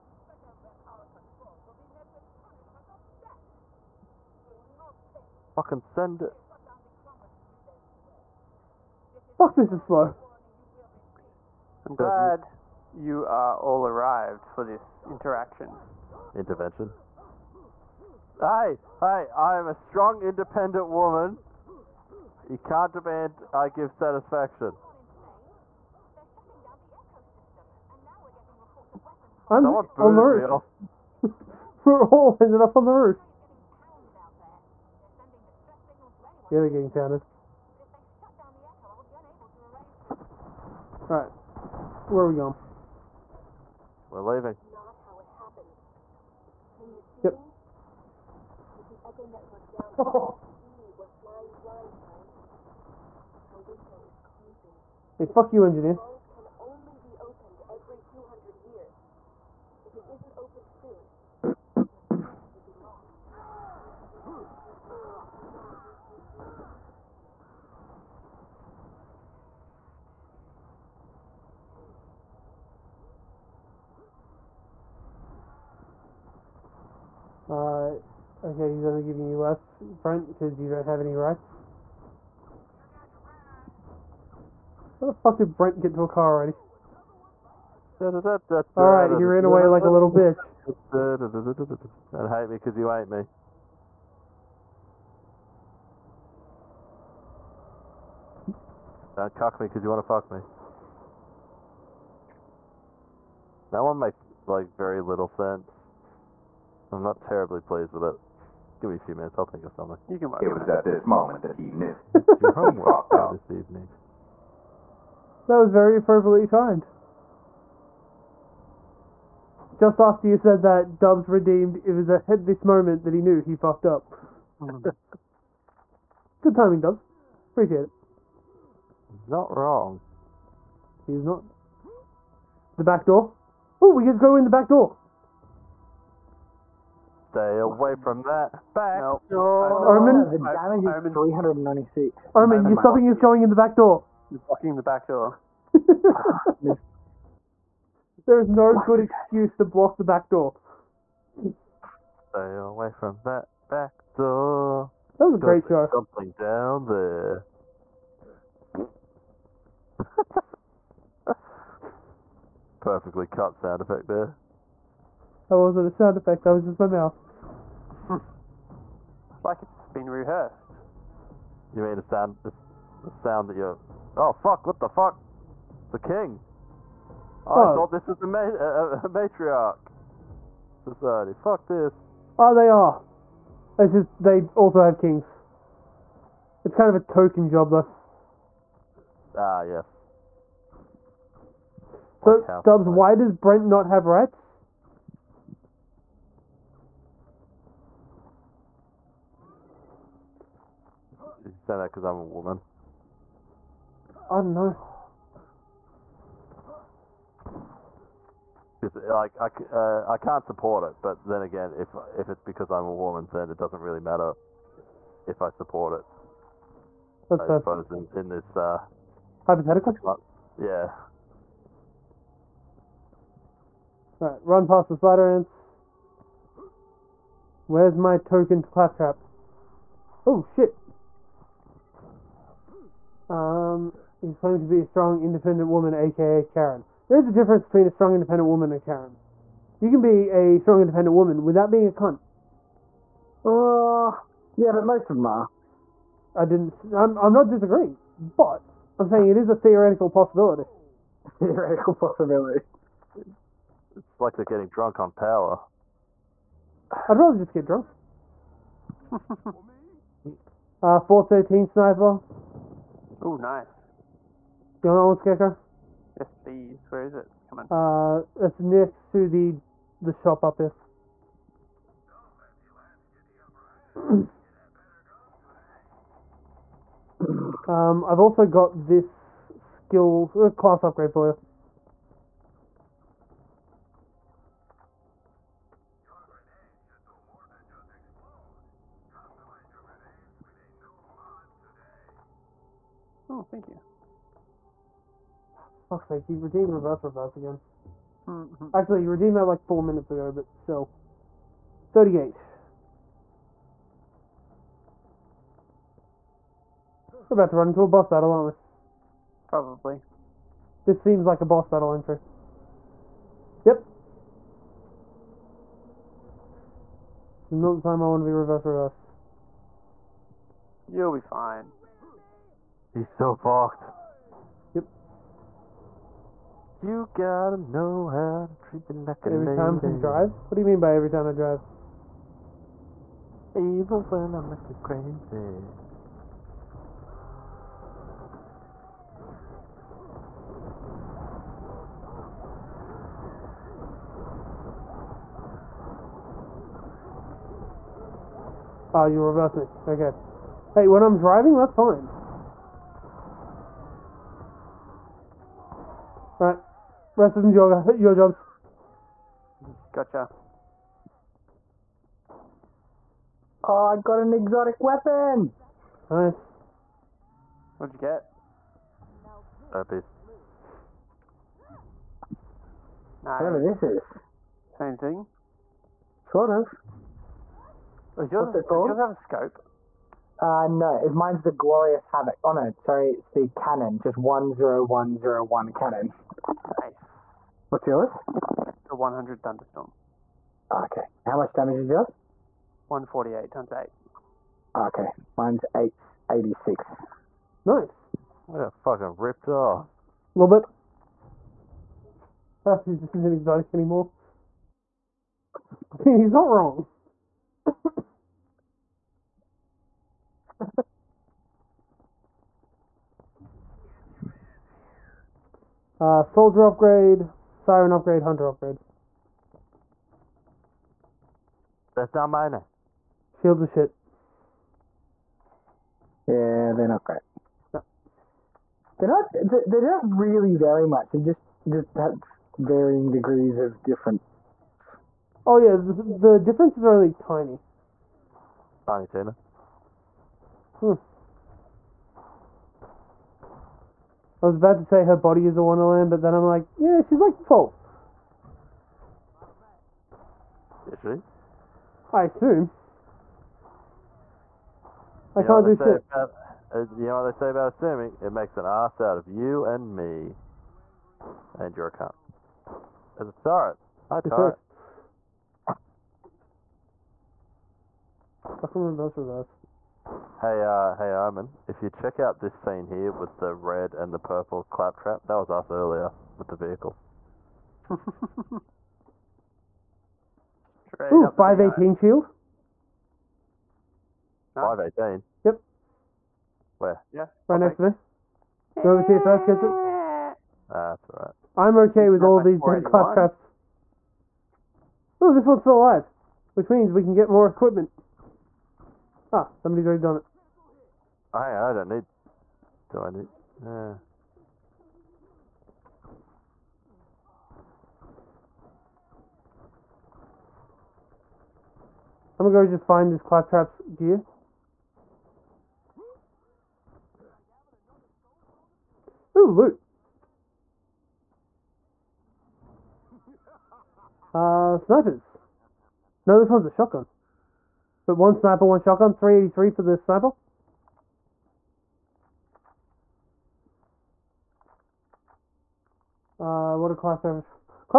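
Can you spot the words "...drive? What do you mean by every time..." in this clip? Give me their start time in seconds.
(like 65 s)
329 s.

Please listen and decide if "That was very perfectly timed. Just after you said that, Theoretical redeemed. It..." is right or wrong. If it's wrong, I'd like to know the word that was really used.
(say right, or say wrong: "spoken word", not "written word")
wrong: "Dubs", not "Theoretical".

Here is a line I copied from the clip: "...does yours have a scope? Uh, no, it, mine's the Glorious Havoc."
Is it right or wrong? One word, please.
right.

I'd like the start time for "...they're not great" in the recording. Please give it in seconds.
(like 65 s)
426 s.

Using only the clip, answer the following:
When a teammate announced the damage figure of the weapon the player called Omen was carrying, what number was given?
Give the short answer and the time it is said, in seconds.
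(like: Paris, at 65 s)
396, at 141 s.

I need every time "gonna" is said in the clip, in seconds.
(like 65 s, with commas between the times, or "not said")
512 s.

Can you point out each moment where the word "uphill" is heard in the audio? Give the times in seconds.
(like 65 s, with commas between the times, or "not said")
not said.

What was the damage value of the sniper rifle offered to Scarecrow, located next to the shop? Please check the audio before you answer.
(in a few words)
413.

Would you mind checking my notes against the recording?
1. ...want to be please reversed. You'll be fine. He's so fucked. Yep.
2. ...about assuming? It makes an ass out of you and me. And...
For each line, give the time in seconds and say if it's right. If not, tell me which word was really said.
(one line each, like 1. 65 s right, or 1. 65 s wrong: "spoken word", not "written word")
1. 318 s wrong: "reverse", not "please"
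2. 457 s right.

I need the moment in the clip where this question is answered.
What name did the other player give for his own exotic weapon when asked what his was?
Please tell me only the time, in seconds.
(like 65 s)
389 s.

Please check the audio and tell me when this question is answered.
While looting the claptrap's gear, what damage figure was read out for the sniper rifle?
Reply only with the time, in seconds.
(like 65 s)
529 s.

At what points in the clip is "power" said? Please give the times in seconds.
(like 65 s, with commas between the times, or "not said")
255 s.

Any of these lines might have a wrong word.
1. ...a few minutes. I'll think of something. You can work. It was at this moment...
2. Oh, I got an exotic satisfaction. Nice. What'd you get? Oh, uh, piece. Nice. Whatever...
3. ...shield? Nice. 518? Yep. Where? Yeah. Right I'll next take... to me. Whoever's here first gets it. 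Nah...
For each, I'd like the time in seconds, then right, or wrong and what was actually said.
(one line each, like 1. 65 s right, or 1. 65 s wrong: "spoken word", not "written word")
1. 108 s right
2. 363 s wrong: "weapon", not "satisfaction"
3. 481 s right.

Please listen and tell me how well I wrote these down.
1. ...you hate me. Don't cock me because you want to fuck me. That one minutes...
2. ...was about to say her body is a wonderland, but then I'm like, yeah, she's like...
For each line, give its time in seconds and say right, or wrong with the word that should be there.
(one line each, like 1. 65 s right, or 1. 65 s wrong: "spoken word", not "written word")
1. 92 s wrong: "makes", not "minutes"
2. 444 s right.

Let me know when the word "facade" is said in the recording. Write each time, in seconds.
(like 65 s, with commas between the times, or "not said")
not said.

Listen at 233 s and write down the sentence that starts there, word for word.
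Um, he's claimed to be a strong, independent woman, aka Karen.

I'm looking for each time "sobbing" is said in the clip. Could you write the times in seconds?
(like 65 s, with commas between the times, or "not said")
142 s.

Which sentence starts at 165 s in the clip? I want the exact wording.
That wasn't a sound effect, that was just my mouth.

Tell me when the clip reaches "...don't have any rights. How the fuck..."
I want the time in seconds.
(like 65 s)
80 s.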